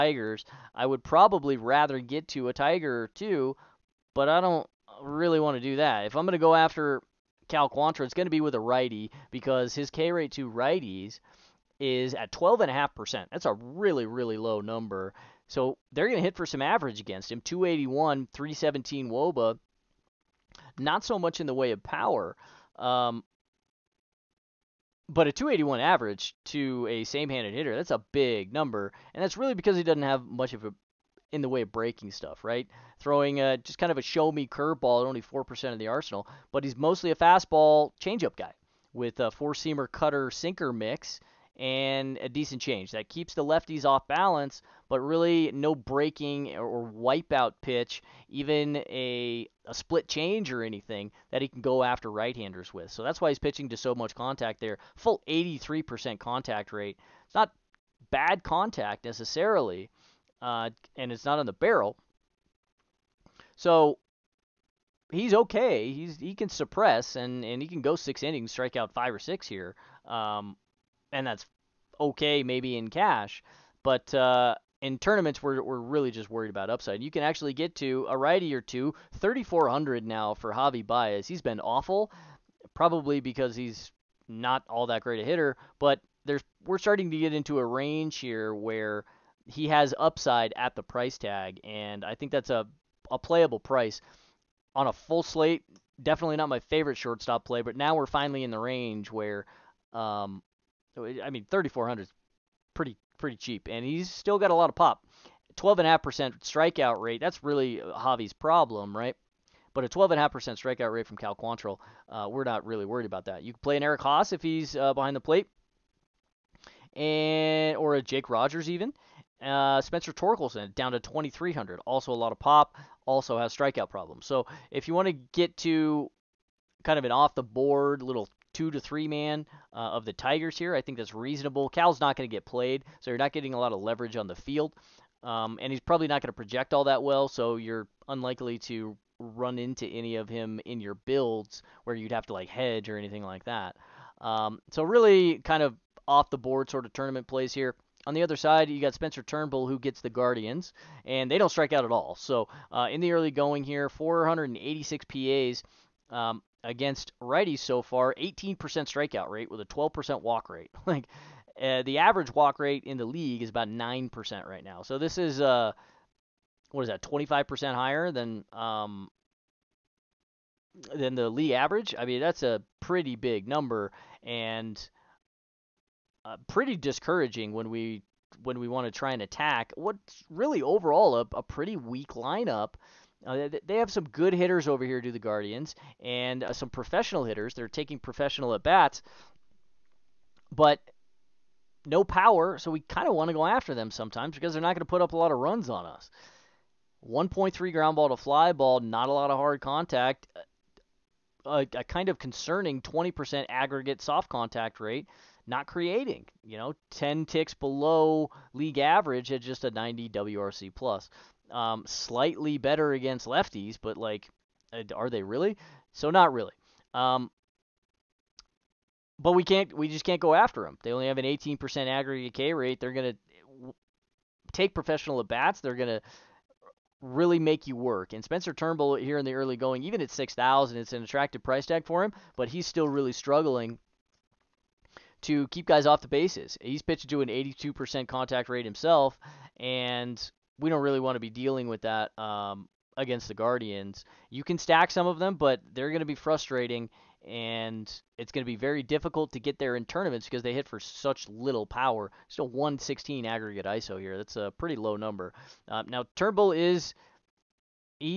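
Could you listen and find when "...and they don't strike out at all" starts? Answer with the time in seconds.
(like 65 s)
151 s.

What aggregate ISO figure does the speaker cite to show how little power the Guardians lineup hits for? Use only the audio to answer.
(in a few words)
116.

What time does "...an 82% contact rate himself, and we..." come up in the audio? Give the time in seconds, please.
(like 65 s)
237 s.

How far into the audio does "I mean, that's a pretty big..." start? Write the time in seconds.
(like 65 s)
171 s.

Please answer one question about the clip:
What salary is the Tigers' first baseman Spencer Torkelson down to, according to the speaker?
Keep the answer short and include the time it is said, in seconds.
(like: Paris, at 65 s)
2,300, at 121 s.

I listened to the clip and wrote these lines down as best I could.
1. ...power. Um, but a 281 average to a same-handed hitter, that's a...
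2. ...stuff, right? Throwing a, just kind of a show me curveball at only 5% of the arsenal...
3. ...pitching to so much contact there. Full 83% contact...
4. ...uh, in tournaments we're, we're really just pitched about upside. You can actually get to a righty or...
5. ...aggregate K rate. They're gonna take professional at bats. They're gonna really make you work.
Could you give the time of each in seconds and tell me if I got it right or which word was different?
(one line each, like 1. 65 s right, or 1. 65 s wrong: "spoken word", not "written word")
1. 21 s right
2. 32 s wrong: "4", not "5"
3. 53 s right
4. 74 s wrong: "worried", not "pitched"
5. 221 s right.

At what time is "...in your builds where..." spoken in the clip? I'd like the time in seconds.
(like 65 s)
140 s.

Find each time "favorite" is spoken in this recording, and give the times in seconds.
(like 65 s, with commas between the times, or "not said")
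96 s.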